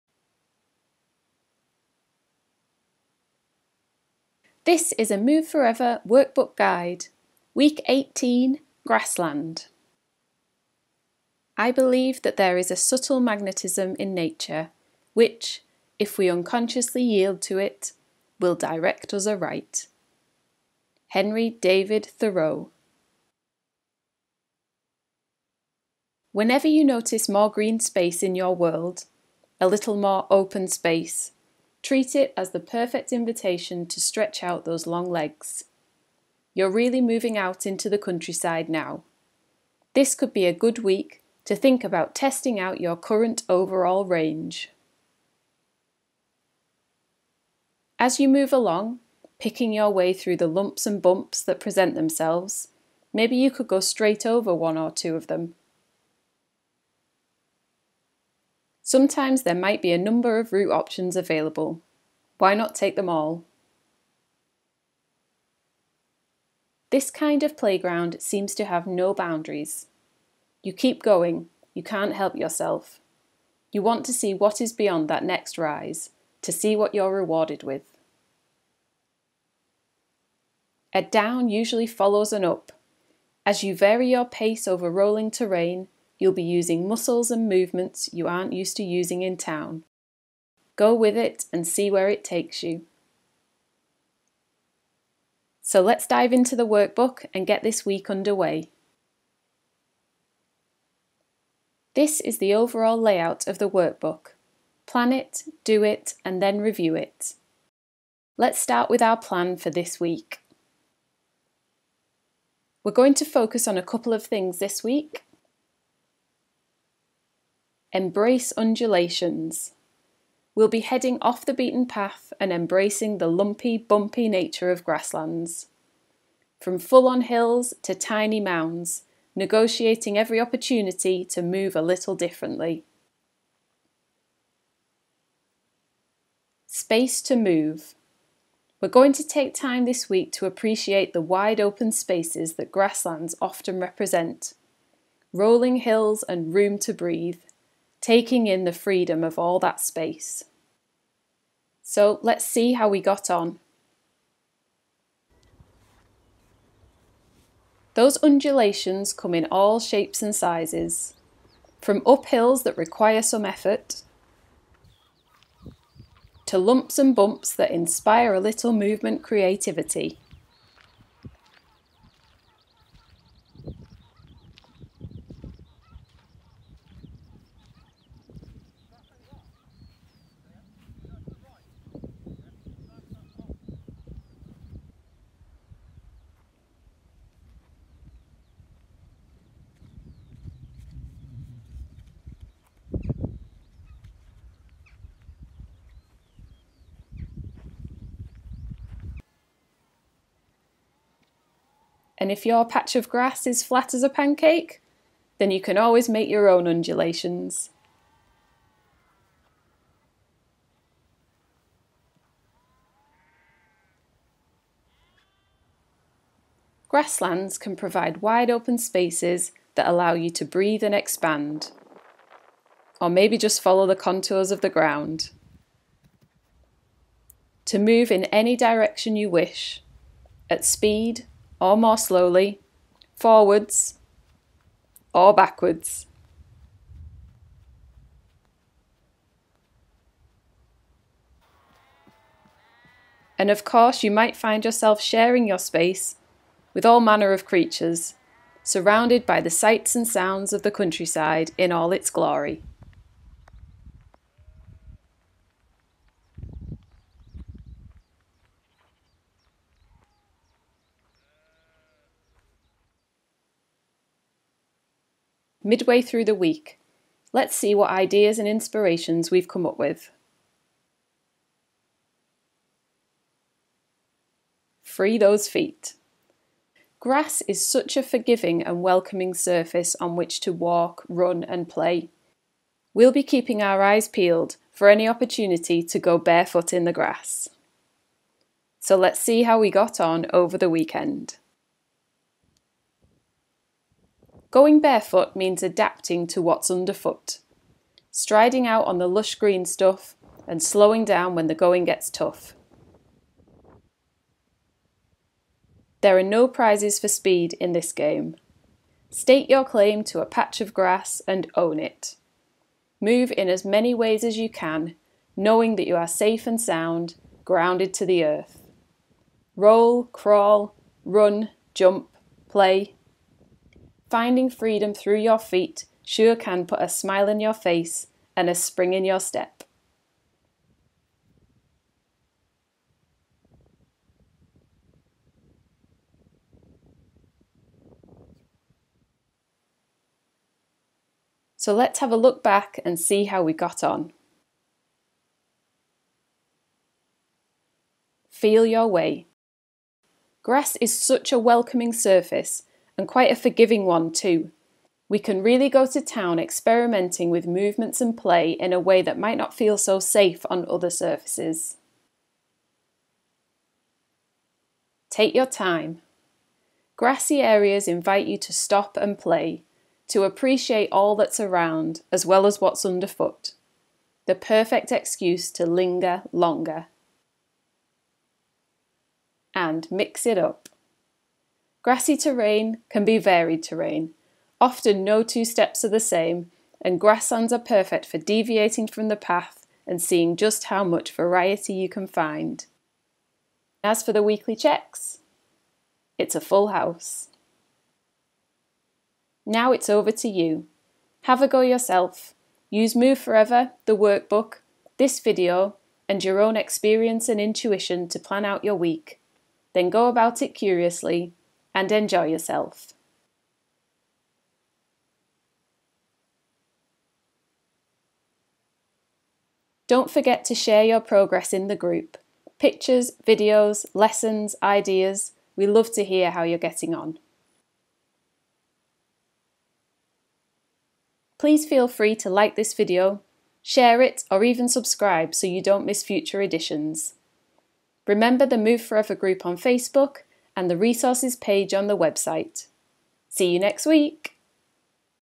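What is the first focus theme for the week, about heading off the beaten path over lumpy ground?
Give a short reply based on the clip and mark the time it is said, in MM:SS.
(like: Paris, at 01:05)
Embrace undulations, at 01:57.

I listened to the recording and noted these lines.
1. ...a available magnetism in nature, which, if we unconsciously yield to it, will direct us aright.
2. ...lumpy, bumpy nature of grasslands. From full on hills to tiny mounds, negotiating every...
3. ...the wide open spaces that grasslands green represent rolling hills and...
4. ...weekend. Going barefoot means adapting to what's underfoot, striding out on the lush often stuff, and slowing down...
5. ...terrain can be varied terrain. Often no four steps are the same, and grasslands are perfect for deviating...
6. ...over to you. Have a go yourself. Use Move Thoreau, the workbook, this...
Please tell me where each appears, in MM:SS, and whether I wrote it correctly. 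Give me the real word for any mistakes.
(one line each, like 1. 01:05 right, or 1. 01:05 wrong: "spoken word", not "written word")
1. 00:12 wrong: "subtle", not "available"
2. 02:03 right
3. 02:21 wrong: "often", not "green"
4. 04:50 wrong: "green", not "often"
5. 06:22 wrong: "two", not "four"
6. 06:39 wrong: "Forever", not "Thoreau".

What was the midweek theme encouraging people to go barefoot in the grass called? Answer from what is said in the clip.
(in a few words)
Free those feet.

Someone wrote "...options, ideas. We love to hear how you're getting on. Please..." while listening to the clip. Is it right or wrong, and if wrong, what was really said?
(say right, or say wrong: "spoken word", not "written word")
wrong: "lessons", not "options".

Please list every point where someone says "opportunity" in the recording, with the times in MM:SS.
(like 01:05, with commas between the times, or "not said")
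02:10, 04:45.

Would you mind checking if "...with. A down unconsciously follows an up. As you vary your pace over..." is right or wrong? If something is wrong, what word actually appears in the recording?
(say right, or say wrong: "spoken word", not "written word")
wrong: "usually", not "unconsciously".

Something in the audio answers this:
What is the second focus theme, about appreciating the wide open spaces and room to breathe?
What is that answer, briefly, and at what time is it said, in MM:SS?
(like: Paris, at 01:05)
Space to move, at 02:16.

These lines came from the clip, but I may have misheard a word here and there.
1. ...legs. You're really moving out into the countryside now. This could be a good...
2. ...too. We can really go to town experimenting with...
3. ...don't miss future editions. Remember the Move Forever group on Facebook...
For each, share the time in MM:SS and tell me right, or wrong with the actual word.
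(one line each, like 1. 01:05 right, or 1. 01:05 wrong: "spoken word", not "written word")
1. 00:35 right
2. 05:54 right
3. 07:15 right.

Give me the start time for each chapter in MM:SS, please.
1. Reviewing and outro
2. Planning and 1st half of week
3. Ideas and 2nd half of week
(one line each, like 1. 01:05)
1. 05:40
2. 01:35
3. 04:24.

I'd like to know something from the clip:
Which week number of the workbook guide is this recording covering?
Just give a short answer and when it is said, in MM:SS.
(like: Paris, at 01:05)
18, at 00:07.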